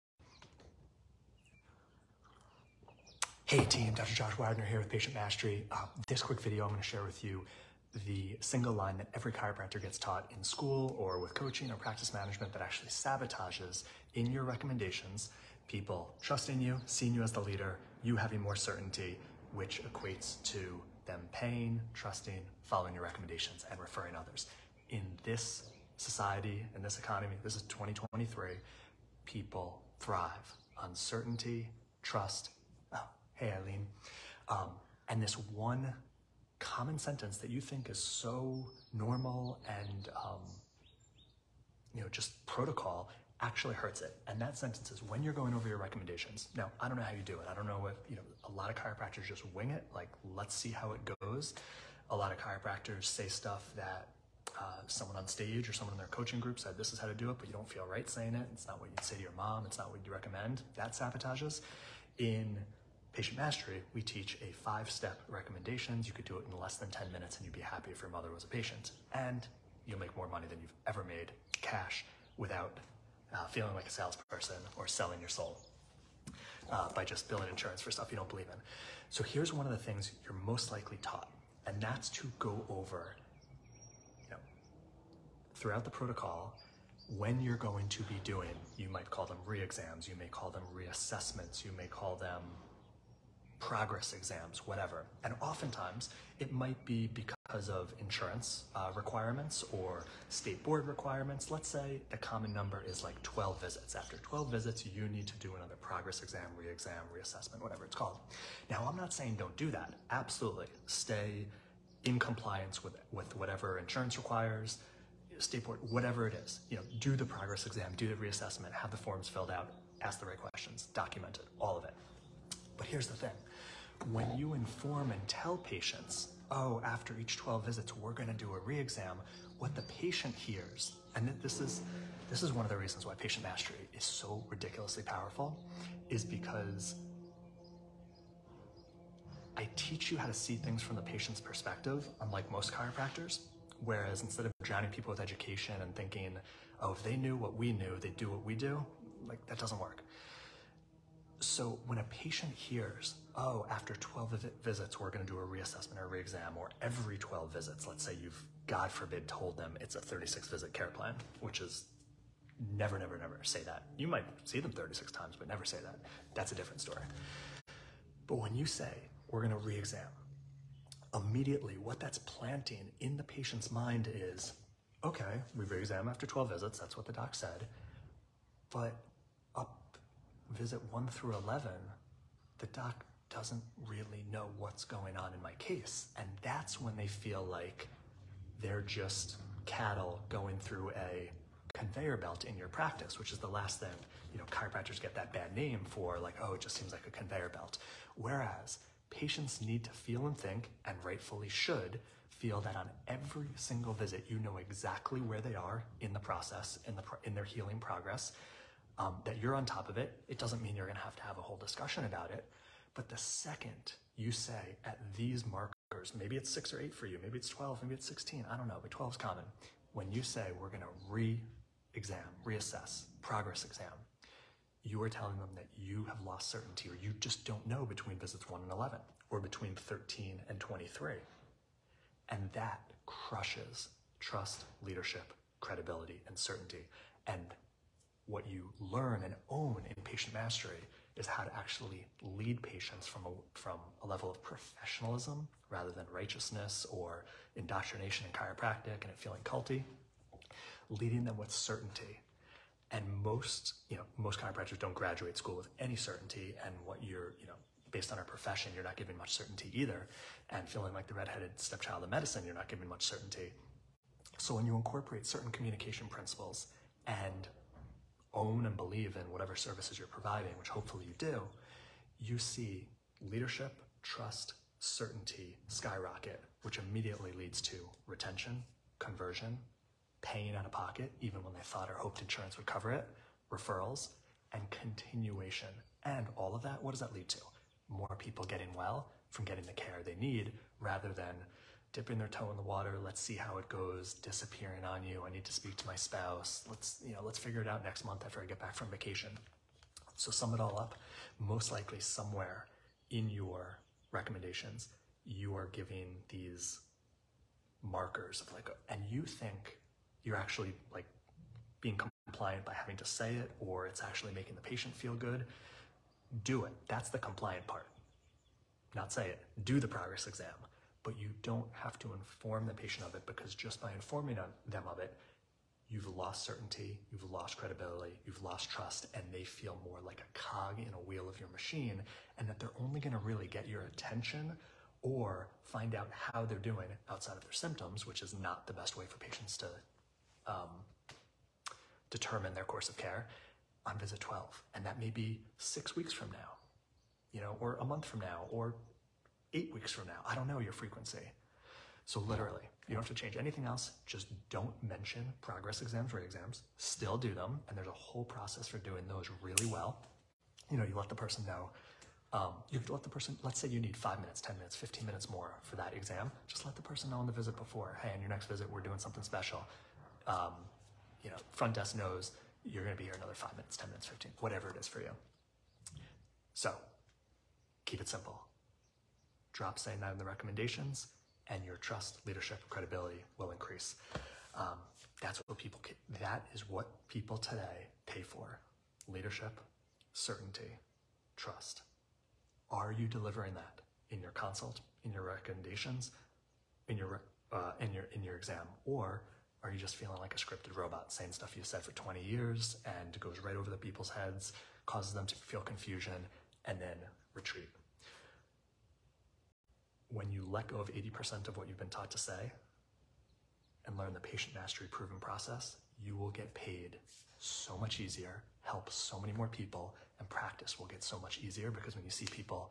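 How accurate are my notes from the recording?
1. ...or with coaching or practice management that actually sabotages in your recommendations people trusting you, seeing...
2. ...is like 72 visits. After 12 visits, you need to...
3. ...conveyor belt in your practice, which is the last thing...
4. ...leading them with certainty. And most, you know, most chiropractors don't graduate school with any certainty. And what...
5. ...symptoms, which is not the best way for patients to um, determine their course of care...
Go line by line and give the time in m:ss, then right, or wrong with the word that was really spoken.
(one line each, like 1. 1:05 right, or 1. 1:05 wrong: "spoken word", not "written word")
1. 0:10 right
2. 1:42 wrong: "12", not "72"
3. 3:11 right
4. 4:10 right
5. 5:37 right.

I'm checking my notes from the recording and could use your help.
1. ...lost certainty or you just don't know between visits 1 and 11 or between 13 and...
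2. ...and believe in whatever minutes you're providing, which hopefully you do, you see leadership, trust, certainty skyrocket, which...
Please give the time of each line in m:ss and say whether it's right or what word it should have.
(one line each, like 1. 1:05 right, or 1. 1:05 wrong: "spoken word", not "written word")
1. 3:46 right
2. 4:28 wrong: "services", not "minutes".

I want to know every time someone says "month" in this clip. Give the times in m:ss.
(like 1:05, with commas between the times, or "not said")
4:58, 5:47.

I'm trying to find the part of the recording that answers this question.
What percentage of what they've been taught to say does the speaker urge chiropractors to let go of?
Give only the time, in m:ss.
6:50.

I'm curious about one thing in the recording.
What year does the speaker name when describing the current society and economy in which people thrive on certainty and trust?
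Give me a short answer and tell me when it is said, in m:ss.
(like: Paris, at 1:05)
2023, at 0:27.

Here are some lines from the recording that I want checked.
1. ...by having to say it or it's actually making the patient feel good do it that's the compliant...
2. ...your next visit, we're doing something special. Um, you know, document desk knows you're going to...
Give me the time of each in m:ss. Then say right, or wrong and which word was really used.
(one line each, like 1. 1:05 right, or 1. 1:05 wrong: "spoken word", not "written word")
1. 5:12 right
2. 6:08 wrong: "front", not "document".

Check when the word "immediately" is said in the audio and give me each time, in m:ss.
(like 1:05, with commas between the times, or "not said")
2:51, 4:36.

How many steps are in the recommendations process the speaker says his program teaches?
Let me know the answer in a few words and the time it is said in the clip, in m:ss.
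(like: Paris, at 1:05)
5, at 1:04.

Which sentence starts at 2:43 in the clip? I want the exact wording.
You might see them 36 times, but never say that.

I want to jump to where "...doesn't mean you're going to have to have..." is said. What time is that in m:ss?
3:30.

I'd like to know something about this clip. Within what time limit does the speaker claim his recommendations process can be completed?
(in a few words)
less than 10 minutes.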